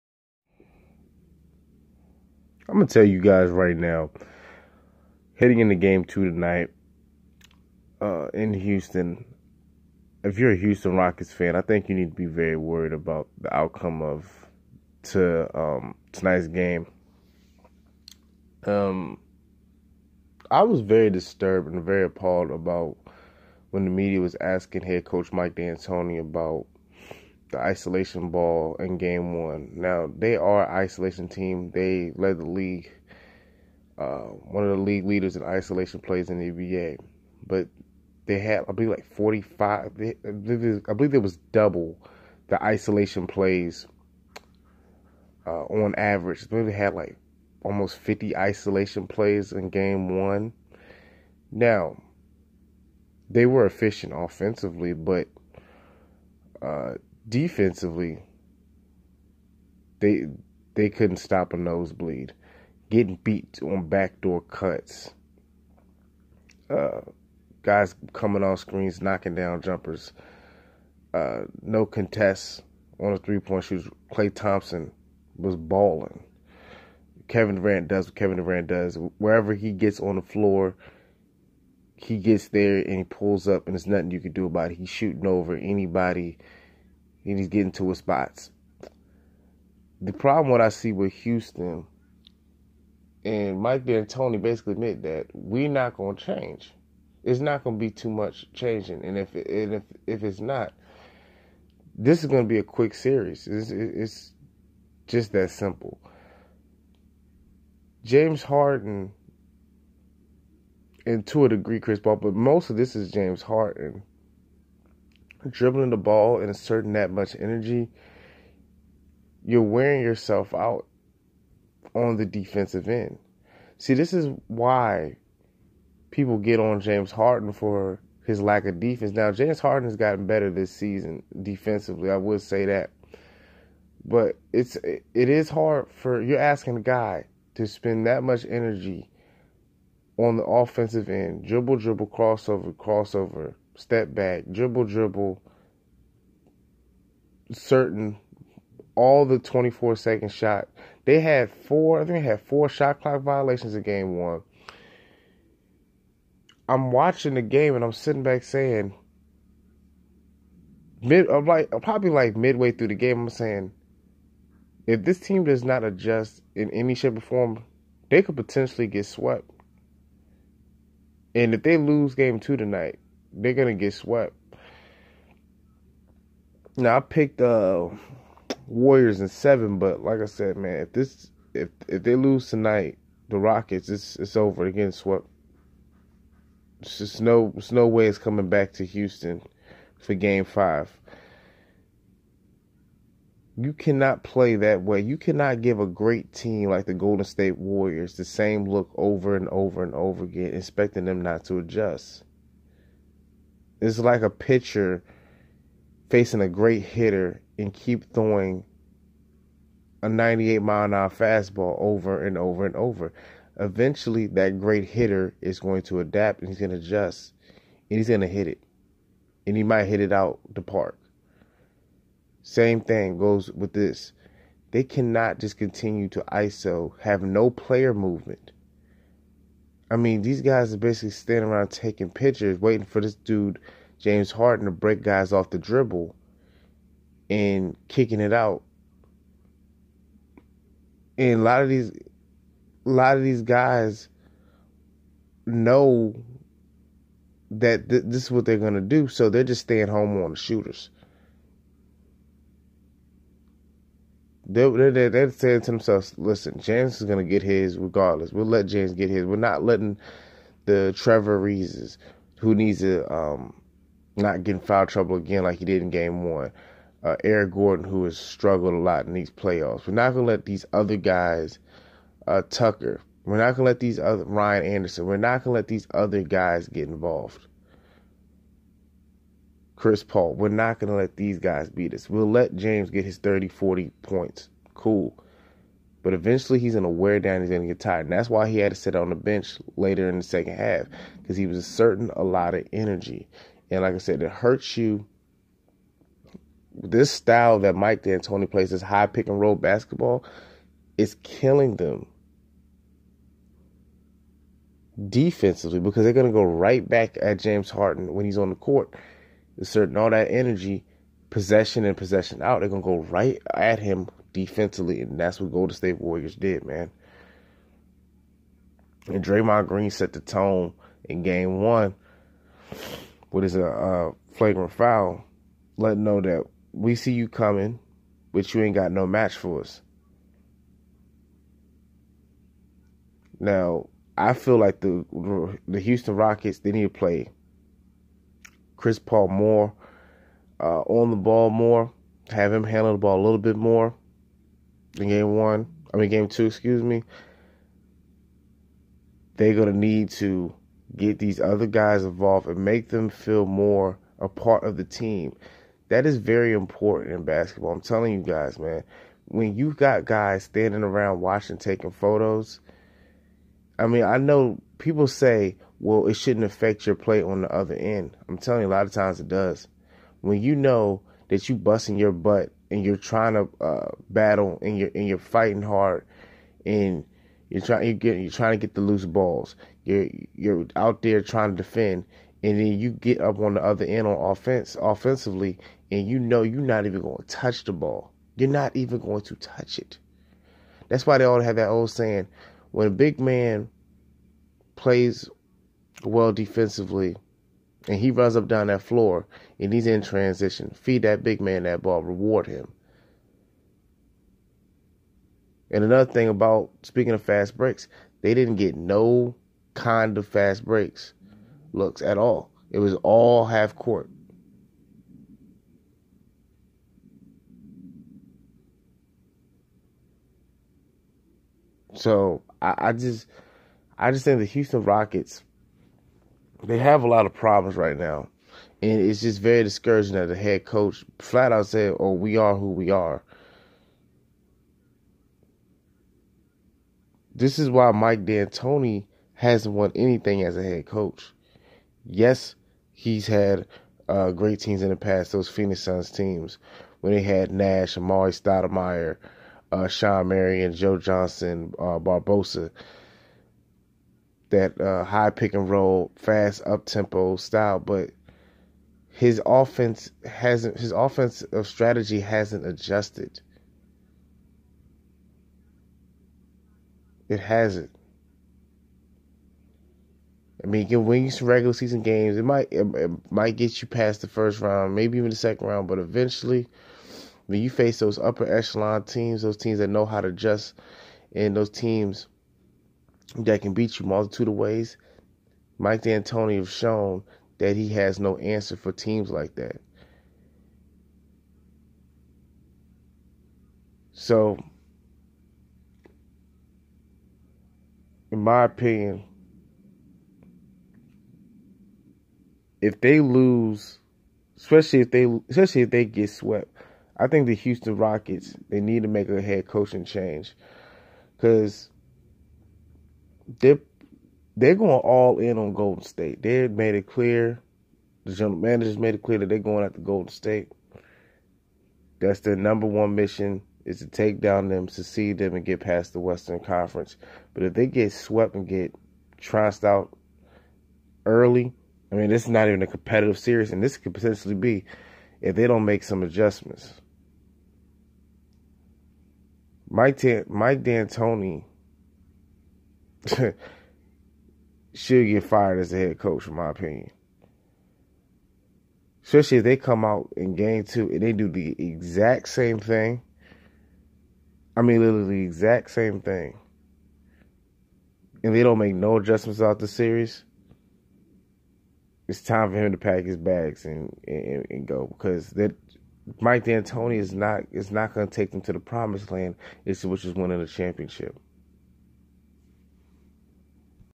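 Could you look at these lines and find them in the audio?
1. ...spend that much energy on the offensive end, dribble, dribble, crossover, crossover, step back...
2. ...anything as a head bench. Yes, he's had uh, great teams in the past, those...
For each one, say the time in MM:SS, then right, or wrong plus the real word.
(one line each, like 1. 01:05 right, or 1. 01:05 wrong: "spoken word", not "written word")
1. 02:17 right
2. 07:19 wrong: "coach", not "bench".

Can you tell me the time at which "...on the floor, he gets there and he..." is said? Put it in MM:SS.
01:20.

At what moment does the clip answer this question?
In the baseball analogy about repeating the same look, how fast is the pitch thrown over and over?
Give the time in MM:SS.
03:30.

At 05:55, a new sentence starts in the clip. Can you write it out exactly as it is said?
That is very important in basketball.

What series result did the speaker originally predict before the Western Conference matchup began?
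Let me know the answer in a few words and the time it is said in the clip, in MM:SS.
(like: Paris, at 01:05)
Warriors in seven, at 02:58.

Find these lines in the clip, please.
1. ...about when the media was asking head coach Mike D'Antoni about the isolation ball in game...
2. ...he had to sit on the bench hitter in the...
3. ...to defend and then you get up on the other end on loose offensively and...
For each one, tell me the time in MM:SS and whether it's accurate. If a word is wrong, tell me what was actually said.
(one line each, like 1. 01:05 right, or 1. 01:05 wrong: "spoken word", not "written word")
1. 00:22 right
2. 04:48 wrong: "later", not "hitter"
3. 06:21 wrong: "offense", not "loose".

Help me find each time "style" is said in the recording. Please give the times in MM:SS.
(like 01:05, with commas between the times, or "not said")
04:57, 07:37.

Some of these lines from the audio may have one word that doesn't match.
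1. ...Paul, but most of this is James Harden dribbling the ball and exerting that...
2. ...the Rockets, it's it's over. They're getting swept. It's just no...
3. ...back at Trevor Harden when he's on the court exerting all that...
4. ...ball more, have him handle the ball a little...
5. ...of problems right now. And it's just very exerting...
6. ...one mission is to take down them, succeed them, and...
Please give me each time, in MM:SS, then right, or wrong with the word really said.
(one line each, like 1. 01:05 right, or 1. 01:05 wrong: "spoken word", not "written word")
1. 01:51 right
2. 03:03 right
3. 05:06 wrong: "James", not "Trevor"
4. 05:41 right
5. 07:07 wrong: "discouraging", not "exerting"
6. 08:42 right.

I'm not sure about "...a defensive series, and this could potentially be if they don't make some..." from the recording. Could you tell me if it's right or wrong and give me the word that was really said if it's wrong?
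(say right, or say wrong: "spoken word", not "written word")
wrong: "competitive", not "defensive".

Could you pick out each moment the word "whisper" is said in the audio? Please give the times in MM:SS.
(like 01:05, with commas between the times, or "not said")
not said.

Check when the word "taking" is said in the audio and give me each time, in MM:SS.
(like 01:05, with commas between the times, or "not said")
03:51, 06:01.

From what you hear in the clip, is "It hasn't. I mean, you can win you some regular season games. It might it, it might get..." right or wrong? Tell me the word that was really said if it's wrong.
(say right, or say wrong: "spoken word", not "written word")
right.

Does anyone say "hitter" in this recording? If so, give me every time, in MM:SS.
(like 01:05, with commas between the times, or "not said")
03:26, 03:34.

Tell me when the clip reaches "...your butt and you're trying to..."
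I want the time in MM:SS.
06:11.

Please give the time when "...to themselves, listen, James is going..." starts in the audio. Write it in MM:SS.
04:15.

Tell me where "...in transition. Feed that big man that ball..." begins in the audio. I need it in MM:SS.
06:39.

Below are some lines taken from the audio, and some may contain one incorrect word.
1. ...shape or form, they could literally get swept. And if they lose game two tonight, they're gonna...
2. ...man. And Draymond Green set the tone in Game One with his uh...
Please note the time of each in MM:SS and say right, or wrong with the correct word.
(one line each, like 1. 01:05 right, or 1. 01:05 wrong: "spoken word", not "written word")
1. 02:46 wrong: "potentially", not "literally"
2. 05:16 right.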